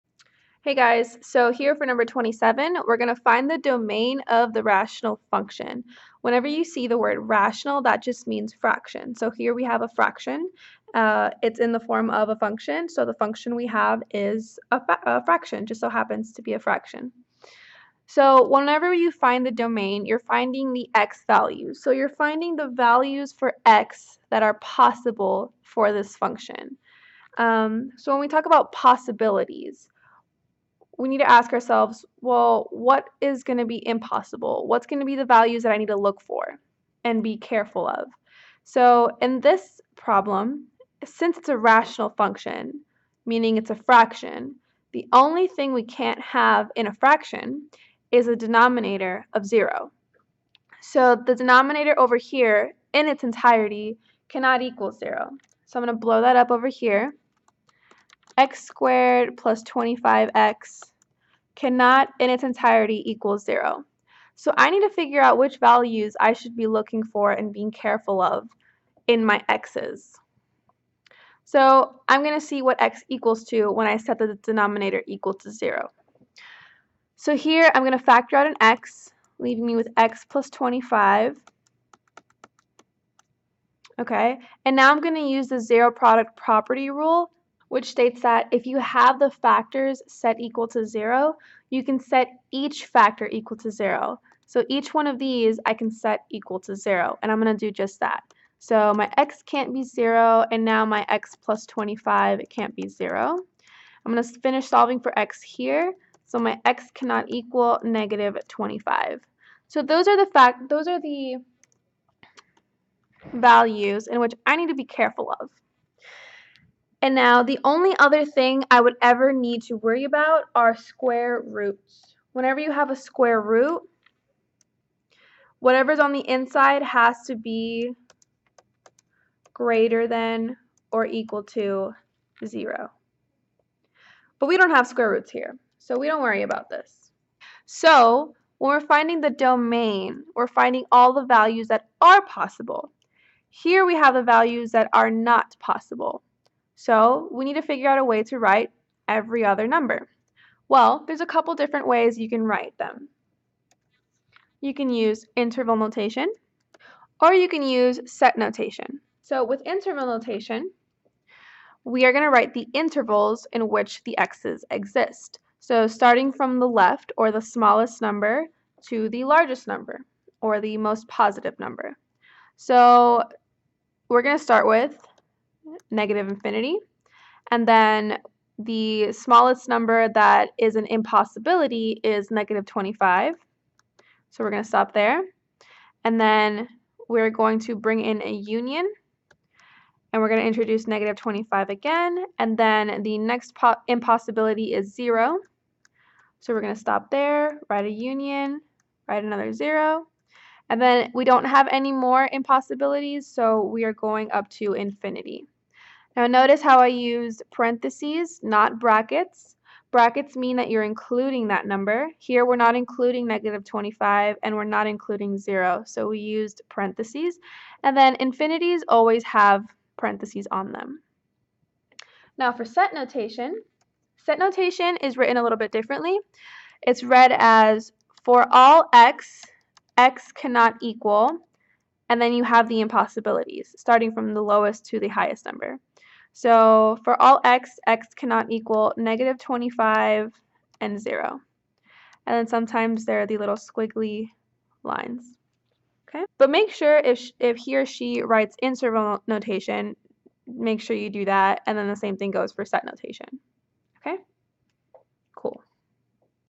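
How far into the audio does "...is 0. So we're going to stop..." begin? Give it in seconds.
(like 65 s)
194 s.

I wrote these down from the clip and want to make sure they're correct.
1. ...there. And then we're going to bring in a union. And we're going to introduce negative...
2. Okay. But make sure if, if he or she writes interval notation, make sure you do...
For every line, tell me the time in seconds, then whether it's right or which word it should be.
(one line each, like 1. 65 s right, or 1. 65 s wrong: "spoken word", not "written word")
1. 184 s right
2. 246 s right.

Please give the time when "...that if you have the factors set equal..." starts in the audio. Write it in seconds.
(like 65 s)
88 s.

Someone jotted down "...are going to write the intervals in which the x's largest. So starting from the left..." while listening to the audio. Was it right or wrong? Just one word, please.
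wrong.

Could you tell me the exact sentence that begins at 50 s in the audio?
So the denominator over here in its entirety cannot equal zero.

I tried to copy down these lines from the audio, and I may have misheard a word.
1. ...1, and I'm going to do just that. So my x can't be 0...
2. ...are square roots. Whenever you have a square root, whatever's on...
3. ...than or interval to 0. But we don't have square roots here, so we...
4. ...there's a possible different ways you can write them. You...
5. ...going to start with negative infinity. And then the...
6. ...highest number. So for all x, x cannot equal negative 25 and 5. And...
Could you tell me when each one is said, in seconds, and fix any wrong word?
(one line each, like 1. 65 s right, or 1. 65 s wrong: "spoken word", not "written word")
1. 96 s wrong: "0", not "1"
2. 120 s right
3. 130 s wrong: "equal", not "interval"
4. 151 s wrong: "couple", not "possible"
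5. 174 s right
6. 235 s wrong: "0", not "5".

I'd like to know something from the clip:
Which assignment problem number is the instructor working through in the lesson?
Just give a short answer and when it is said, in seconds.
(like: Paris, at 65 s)
27, at 2 s.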